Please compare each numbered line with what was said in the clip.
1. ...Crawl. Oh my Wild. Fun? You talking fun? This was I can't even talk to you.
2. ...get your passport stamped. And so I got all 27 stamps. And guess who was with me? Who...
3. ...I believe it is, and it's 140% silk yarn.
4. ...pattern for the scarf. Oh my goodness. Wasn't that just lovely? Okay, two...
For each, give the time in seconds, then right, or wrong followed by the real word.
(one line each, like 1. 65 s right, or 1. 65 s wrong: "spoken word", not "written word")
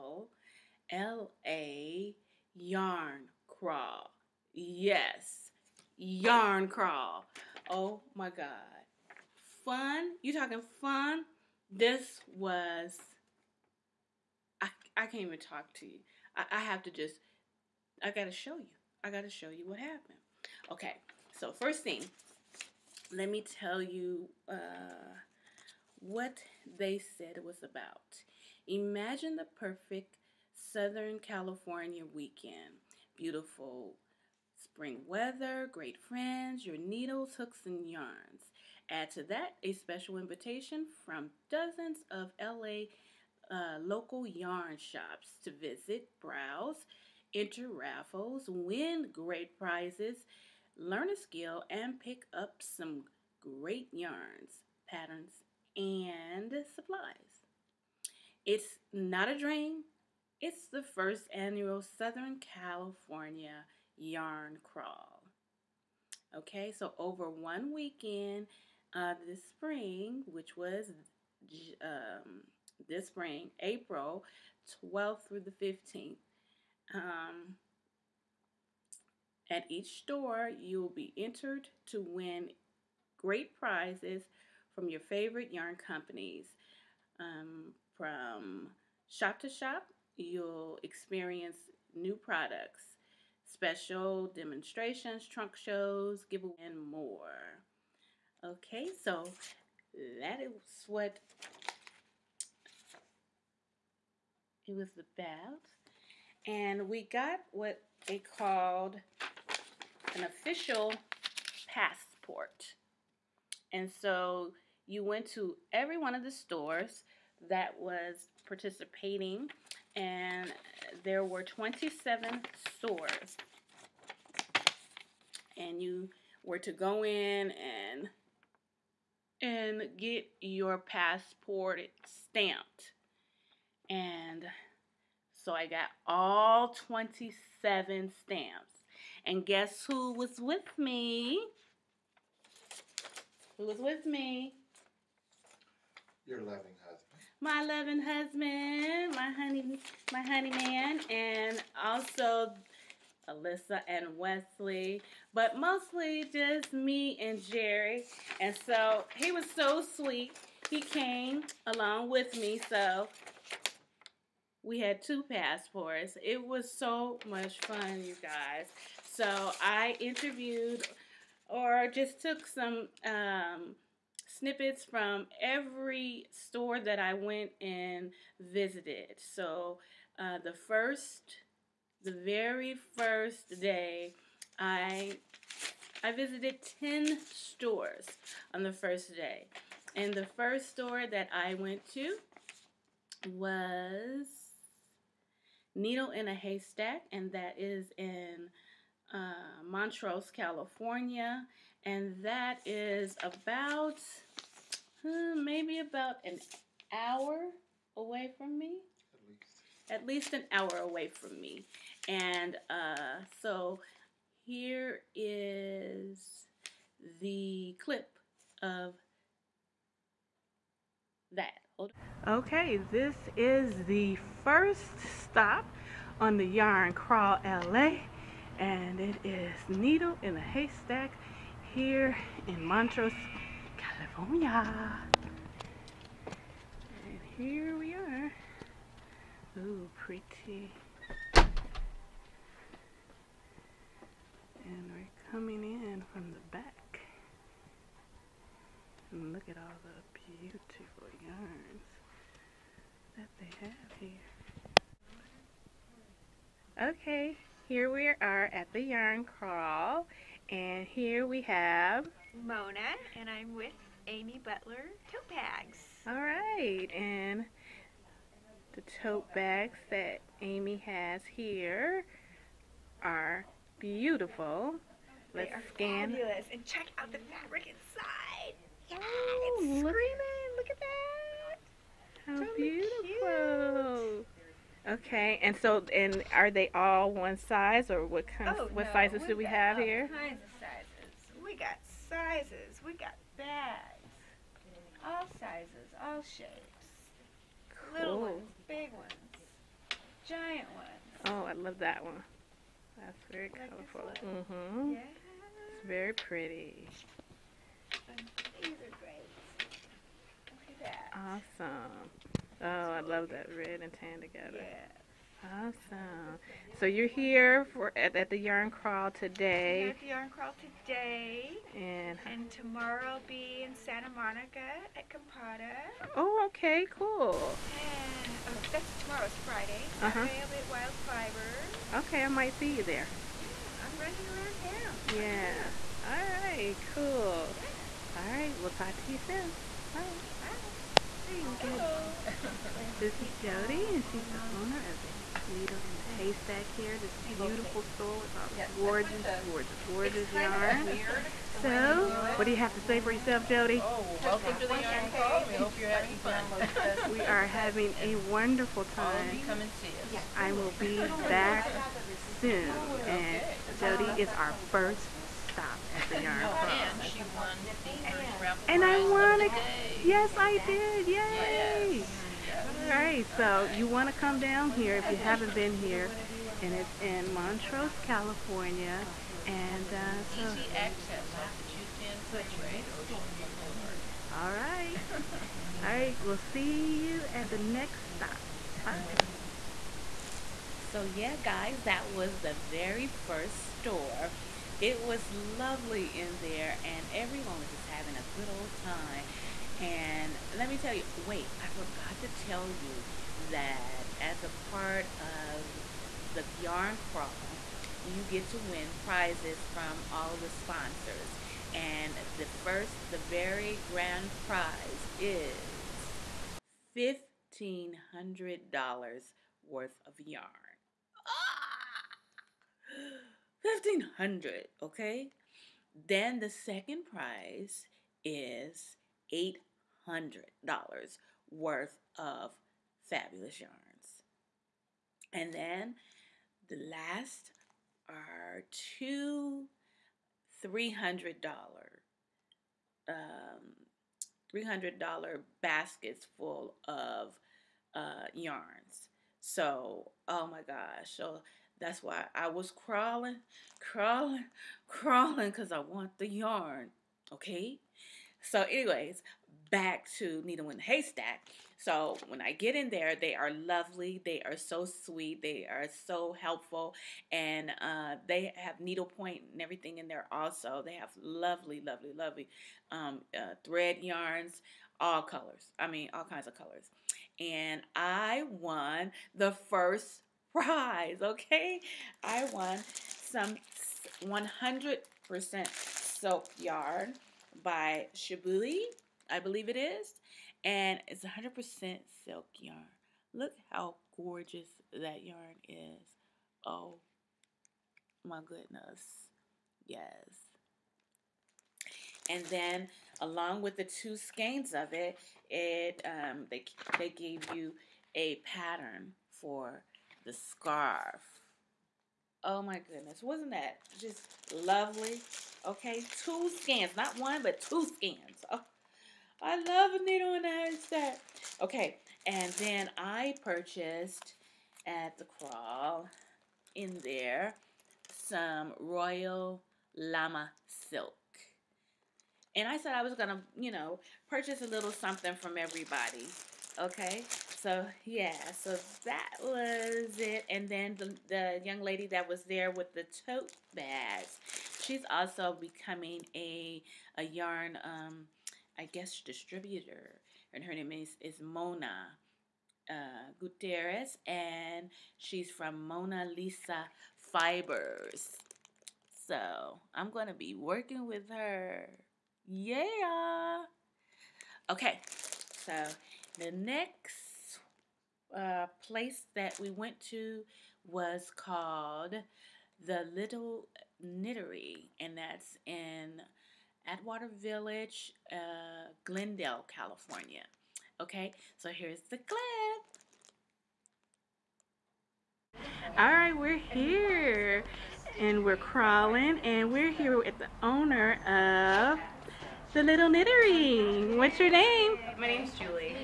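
1. 6 s wrong: "God", not "Wild"
2. 129 s right
3. 489 s wrong: "100", not "140"
4. 508 s right.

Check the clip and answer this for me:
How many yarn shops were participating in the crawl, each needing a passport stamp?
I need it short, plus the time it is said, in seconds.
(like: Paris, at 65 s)
27, at 121 s.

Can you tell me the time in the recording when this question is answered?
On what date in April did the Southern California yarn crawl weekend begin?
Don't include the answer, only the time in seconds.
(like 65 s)
73 s.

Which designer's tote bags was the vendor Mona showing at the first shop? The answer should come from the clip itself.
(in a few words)
Amy Butler.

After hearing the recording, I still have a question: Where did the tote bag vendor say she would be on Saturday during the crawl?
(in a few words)
Wild Fiber.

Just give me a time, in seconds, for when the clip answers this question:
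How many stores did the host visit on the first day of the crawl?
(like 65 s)
186 s.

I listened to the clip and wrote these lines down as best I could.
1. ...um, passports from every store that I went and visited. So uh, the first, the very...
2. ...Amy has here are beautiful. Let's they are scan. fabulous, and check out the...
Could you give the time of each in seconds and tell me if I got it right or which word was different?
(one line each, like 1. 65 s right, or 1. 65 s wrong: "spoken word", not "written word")
1. 173 s wrong: "snippets", not "passports"
2. 270 s right.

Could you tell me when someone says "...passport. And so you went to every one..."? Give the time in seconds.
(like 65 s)
111 s.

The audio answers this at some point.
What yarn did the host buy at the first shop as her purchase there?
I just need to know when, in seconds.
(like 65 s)
528 s.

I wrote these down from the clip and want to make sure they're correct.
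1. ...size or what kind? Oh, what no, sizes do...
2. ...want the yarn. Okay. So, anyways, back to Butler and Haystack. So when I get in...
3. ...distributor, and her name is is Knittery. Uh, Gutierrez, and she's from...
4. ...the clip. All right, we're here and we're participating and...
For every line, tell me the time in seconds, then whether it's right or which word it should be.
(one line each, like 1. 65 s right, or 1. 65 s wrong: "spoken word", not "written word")
1. 287 s right
2. 455 s wrong: "Needle", not "Butler"
3. 549 s wrong: "Mona", not "Knittery"
4. 582 s wrong: "crawling", not "participating".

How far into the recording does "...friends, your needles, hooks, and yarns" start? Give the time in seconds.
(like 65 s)
35 s.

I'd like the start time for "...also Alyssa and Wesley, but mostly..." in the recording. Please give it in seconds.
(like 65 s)
151 s.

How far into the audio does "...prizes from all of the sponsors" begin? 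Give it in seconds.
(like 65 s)
409 s.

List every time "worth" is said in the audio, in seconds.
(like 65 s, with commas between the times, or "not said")
419 s, 431 s.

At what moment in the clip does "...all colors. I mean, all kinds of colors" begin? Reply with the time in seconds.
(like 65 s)
474 s.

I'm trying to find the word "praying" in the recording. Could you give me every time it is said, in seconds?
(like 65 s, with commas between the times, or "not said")
not said.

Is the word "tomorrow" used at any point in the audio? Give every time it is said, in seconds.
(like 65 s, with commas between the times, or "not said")
322 s, 328 s.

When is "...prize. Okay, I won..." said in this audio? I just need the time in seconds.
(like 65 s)
480 s.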